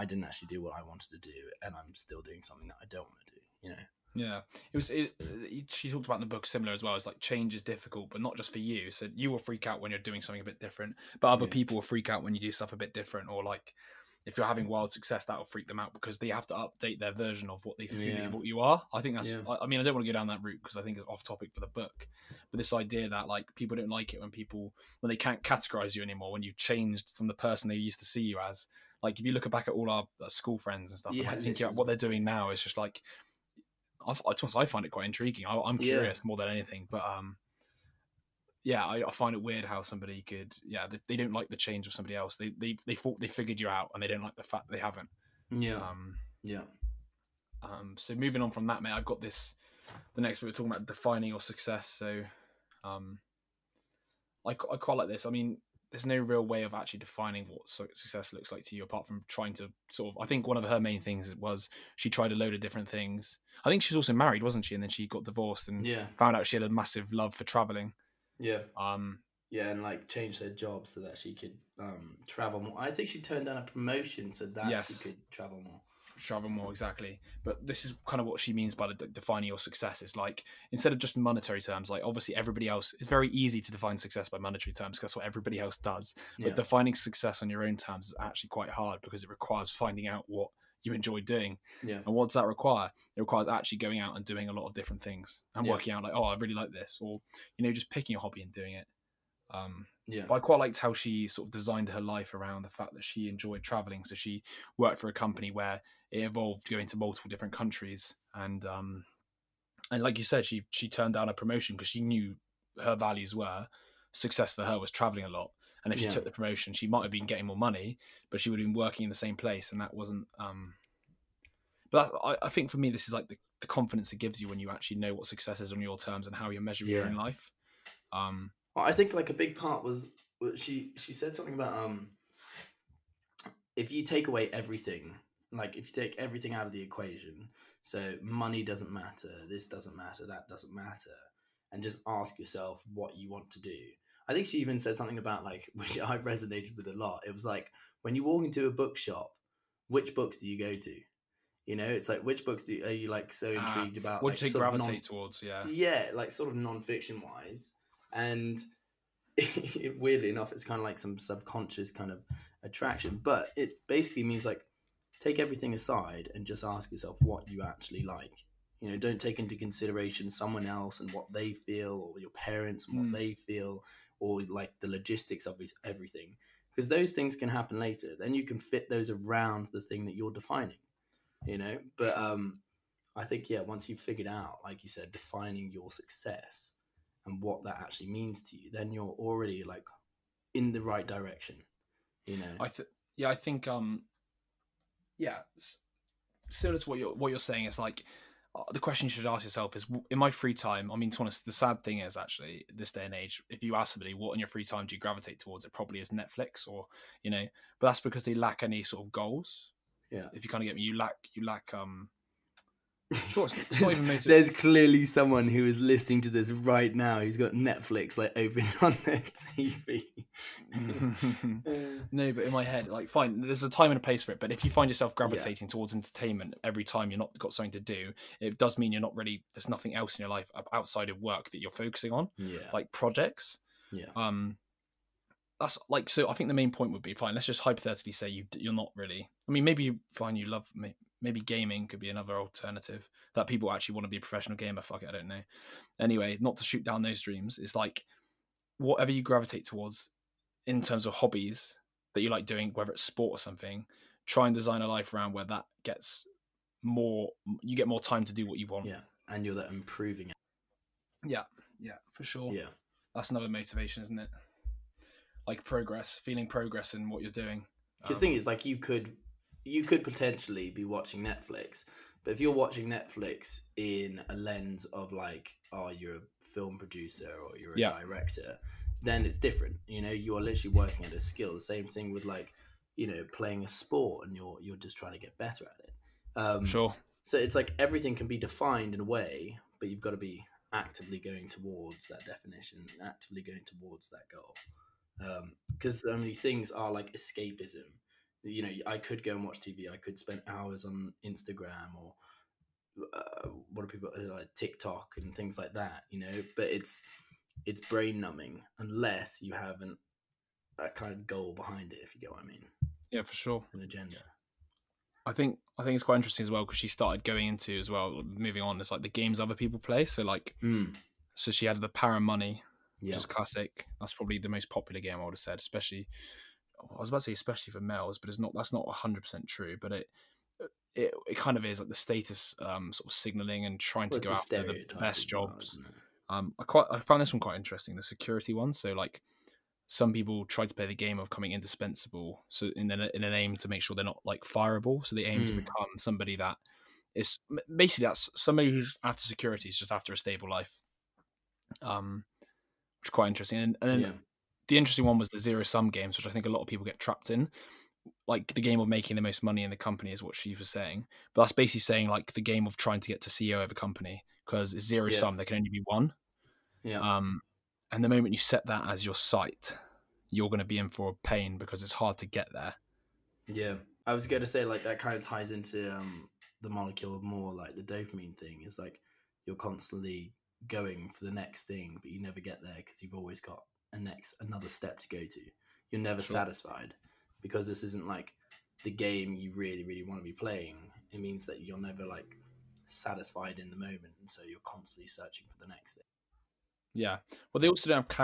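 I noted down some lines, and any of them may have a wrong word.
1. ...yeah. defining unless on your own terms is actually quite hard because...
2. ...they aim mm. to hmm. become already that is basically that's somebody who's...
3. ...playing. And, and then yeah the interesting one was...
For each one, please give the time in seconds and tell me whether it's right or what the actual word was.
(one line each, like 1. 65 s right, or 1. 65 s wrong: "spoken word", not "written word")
1. 86 s wrong: "success", not "unless"
2. 345 s wrong: "somebody", not "already"
3. 353 s wrong: "interesting", not "playing".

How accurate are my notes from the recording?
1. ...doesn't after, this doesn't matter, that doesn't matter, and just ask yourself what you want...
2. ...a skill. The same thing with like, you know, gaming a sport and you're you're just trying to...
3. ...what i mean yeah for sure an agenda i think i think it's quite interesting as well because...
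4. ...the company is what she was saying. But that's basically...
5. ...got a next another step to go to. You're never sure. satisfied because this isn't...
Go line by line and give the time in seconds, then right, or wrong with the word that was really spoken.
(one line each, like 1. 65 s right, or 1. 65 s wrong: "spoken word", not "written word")
1. 138 s wrong: "matter", not "after"
2. 281 s wrong: "playing", not "gaming"
3. 312 s right
4. 359 s right
5. 383 s right.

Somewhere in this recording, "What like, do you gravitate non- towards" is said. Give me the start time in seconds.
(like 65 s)
154 s.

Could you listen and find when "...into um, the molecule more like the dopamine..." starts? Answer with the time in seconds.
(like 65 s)
375 s.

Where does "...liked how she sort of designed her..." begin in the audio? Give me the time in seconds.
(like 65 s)
100 s.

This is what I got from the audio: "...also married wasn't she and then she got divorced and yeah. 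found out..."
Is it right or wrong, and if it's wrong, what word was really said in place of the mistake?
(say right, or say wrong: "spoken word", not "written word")
right.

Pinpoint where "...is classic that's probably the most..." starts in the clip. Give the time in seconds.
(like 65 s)
323 s.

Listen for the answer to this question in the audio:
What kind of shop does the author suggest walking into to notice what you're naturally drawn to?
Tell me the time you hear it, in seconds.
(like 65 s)
148 s.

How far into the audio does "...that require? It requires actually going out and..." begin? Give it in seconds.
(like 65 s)
92 s.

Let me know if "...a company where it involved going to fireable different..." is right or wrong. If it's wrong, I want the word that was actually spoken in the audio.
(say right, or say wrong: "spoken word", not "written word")
wrong: "multiple", not "fireable".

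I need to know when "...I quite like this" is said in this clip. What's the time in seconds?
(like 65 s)
54 s.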